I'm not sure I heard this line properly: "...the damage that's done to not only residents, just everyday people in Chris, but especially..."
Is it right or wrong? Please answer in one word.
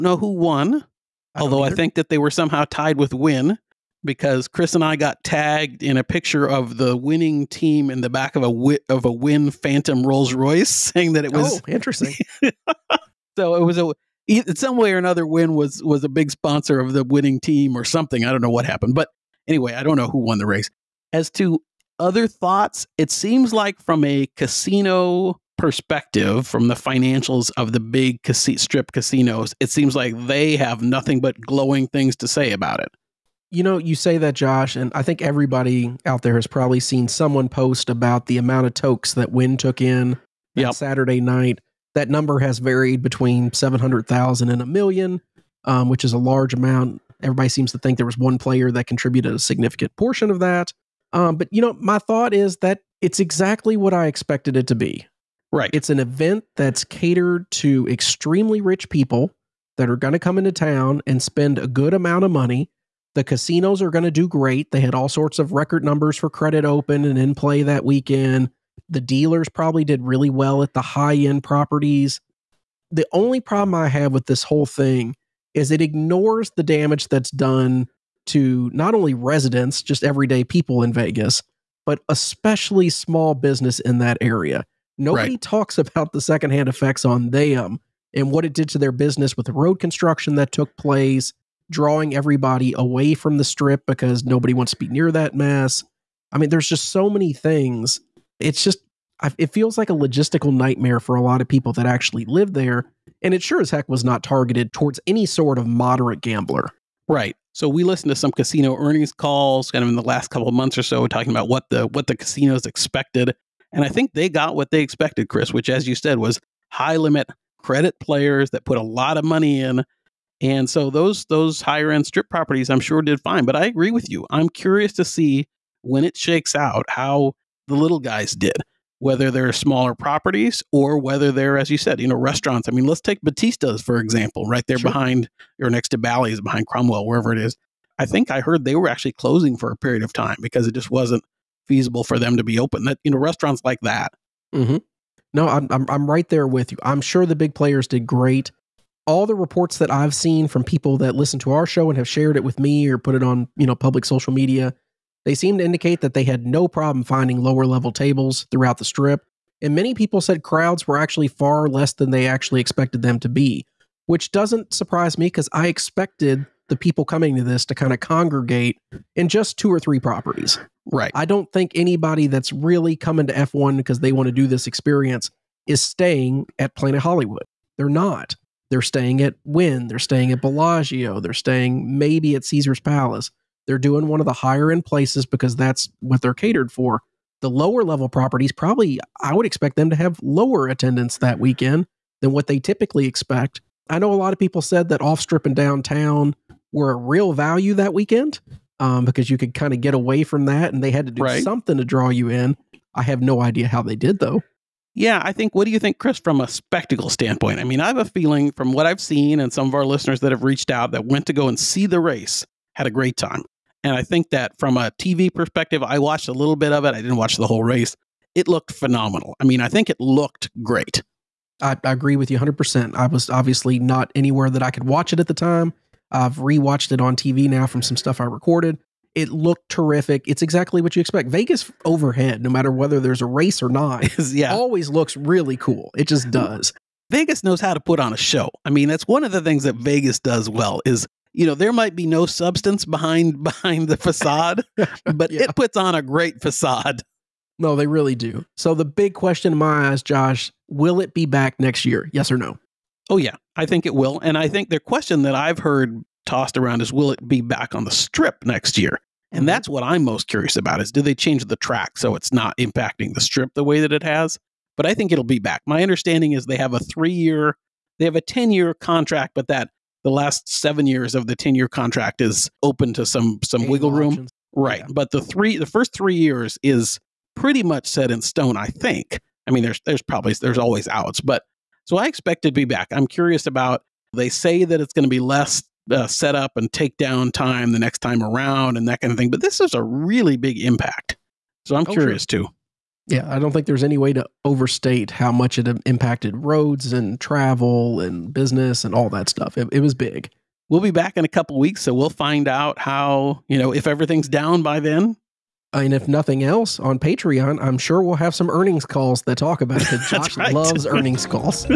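wrong.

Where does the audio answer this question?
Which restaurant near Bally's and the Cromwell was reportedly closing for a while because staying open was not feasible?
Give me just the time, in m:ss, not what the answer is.
2:13.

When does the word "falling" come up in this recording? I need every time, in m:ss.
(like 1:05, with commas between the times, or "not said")
not said.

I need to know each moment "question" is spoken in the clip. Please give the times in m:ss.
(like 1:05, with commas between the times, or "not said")
4:09, 4:14.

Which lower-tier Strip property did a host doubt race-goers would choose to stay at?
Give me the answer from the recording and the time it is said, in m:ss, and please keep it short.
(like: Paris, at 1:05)
Planet Hollywood, at 2:56.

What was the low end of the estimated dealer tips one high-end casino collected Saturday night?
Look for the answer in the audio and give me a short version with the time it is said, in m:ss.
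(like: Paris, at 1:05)
700,000, at 0:43.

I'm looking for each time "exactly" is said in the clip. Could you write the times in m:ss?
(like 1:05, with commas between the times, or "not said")
0:53, 3:50.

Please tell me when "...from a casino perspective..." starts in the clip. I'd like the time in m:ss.
0:23.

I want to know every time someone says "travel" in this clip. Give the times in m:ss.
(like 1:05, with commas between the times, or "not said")
4:57.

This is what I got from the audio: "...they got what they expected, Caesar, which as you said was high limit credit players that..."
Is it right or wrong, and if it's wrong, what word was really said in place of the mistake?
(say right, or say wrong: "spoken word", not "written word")
wrong: "Chris", not "Caesar".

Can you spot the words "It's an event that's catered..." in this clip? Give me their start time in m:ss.
0:55.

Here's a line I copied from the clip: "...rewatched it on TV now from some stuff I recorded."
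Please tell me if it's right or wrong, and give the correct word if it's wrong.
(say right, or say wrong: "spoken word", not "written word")
right.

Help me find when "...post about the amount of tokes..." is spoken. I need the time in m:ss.
0:37.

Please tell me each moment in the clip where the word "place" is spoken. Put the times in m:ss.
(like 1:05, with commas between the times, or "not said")
1:30, 3:04.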